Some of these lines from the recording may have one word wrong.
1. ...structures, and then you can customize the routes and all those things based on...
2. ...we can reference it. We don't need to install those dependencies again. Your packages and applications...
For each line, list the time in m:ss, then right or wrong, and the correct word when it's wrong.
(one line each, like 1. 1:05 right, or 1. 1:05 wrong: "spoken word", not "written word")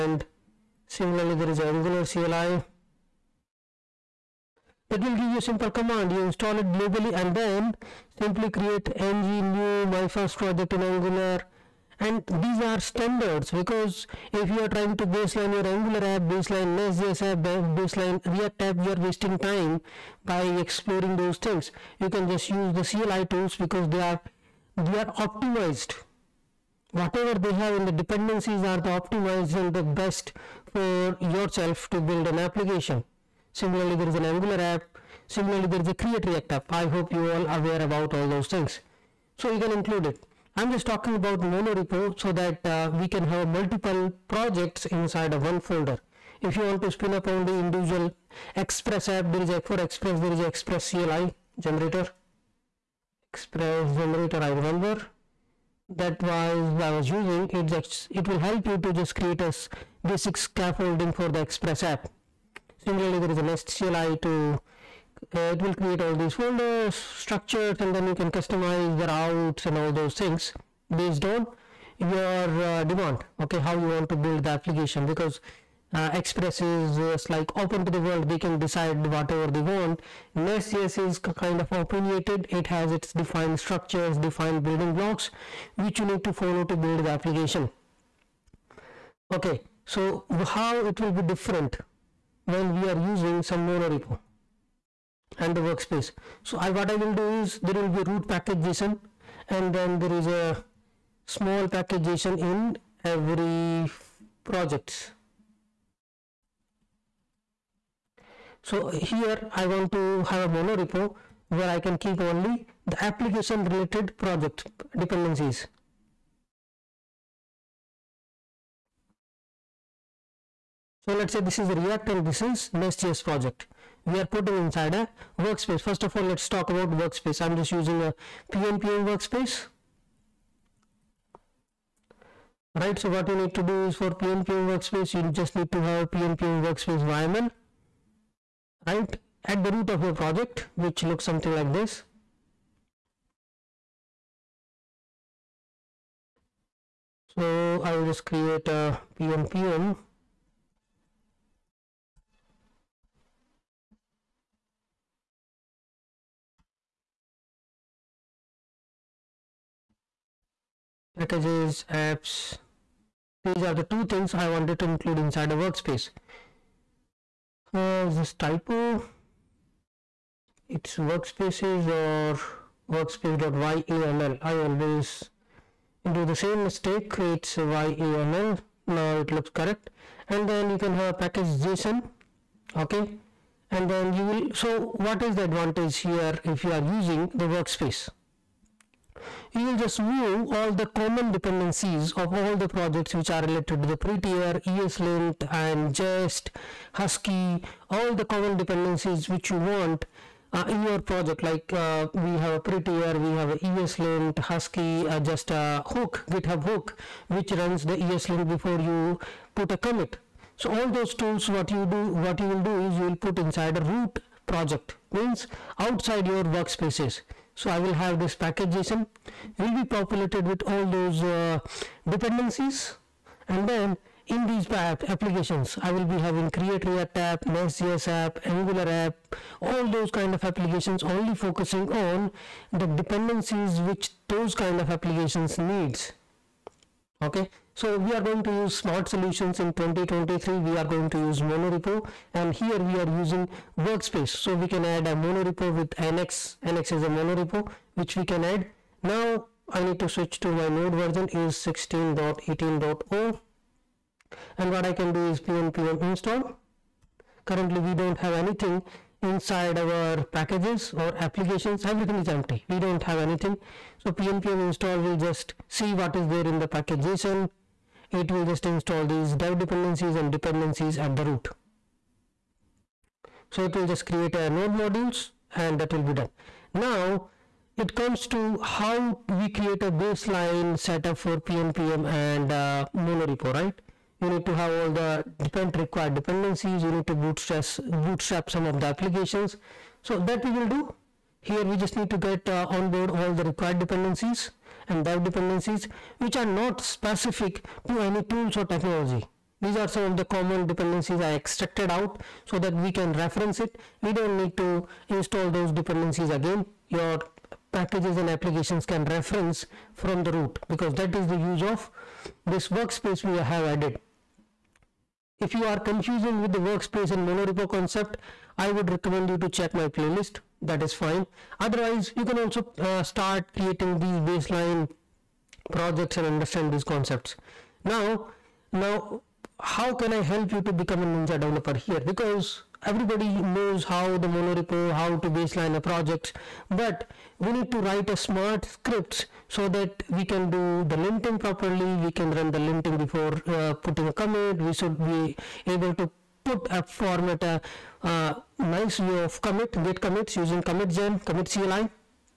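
1. 1:06 right
2. 5:02 right.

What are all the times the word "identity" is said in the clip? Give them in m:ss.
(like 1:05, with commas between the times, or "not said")
not said.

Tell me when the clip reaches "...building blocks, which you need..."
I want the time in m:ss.
1:24.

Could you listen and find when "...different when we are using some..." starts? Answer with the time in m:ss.
1:31.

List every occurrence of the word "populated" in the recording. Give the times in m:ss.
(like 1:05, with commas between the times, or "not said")
3:39.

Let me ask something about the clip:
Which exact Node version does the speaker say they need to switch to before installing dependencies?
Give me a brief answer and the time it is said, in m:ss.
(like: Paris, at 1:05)
16.18.0, at 4:11.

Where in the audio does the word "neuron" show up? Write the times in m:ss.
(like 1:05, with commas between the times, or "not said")
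not said.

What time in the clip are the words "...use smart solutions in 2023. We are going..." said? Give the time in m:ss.
3:58.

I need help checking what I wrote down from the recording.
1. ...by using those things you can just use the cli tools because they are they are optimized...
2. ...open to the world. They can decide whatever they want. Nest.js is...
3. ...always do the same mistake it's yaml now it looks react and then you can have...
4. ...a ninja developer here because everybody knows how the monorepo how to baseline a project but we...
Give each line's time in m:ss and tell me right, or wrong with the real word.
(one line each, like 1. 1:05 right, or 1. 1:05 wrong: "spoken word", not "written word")
1. 0:20 wrong: "exploring", not "using"
2. 1:17 right
3. 2:54 wrong: "correct", not "react"
4. 5:31 right.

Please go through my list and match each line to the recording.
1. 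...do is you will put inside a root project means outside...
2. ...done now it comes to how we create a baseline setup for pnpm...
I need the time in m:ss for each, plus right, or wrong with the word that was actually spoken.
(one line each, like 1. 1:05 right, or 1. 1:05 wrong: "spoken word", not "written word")
1. 3:32 right
2. 4:36 right.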